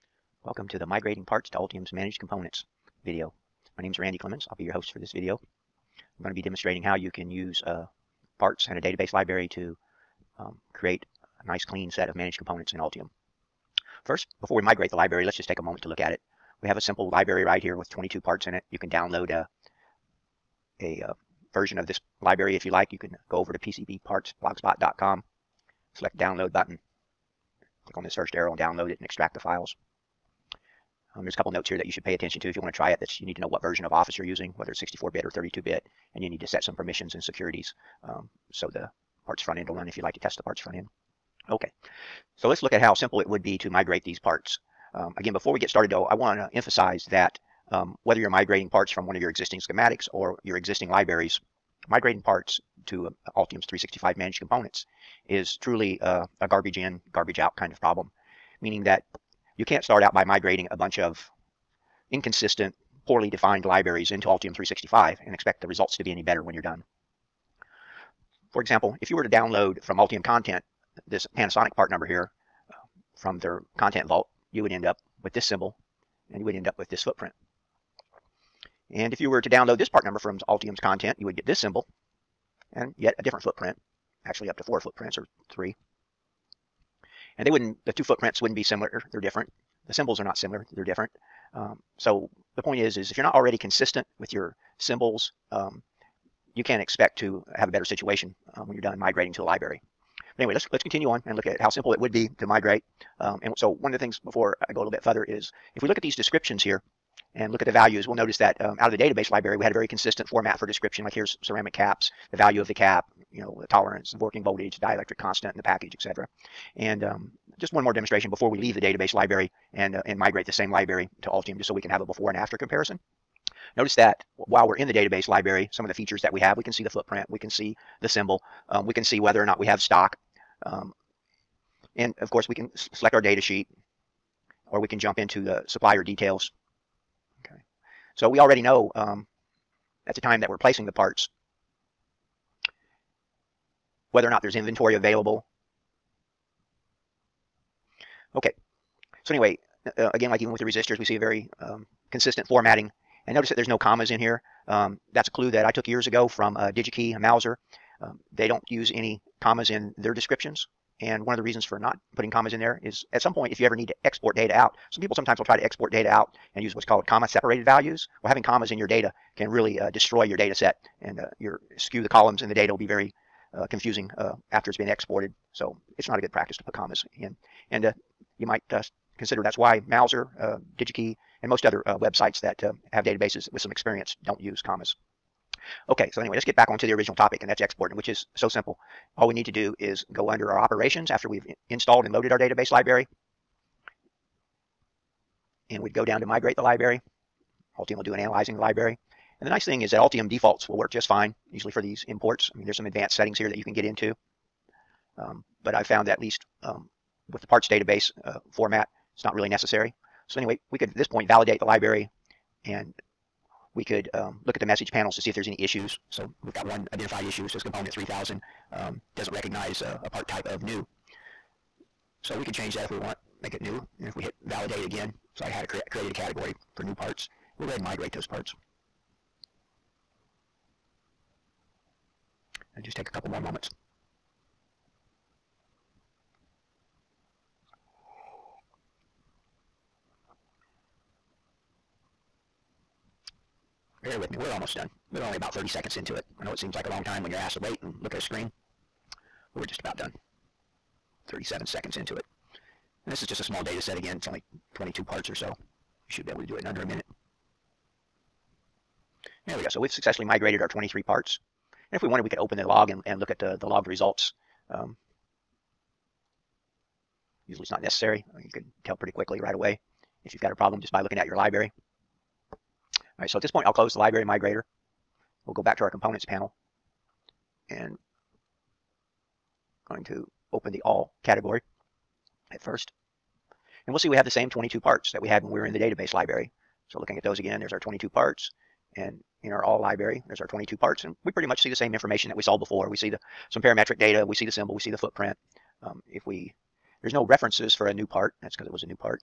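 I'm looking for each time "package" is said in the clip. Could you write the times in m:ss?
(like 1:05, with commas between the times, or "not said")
1:55.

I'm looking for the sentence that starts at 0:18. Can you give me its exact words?
You can download a, uh, a uh, version of this library if you like.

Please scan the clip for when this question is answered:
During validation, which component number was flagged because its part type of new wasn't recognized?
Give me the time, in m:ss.
3:37.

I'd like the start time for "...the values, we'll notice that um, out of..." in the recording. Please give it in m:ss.
1:47.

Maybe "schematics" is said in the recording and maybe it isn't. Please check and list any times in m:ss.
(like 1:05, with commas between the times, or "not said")
0:49.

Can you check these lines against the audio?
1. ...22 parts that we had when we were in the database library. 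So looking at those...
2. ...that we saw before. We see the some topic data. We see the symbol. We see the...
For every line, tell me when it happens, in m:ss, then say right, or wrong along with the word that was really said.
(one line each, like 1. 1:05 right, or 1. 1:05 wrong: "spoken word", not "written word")
1. 4:44 right
2. 4:52 wrong: "parametric", not "topic".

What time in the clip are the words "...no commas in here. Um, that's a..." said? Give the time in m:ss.
2:33.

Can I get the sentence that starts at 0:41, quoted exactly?
Okay, so let's look at how simple it would be to migrate these parts.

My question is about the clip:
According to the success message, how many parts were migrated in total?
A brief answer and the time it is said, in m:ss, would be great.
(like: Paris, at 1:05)
23, at 4:20.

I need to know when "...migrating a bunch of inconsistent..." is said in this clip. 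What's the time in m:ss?
1:00.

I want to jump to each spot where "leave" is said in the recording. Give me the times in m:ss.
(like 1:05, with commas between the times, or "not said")
1:58.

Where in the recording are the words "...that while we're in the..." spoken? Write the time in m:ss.
2:03.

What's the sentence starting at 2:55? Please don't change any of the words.
So it's not a good practice to put commas in.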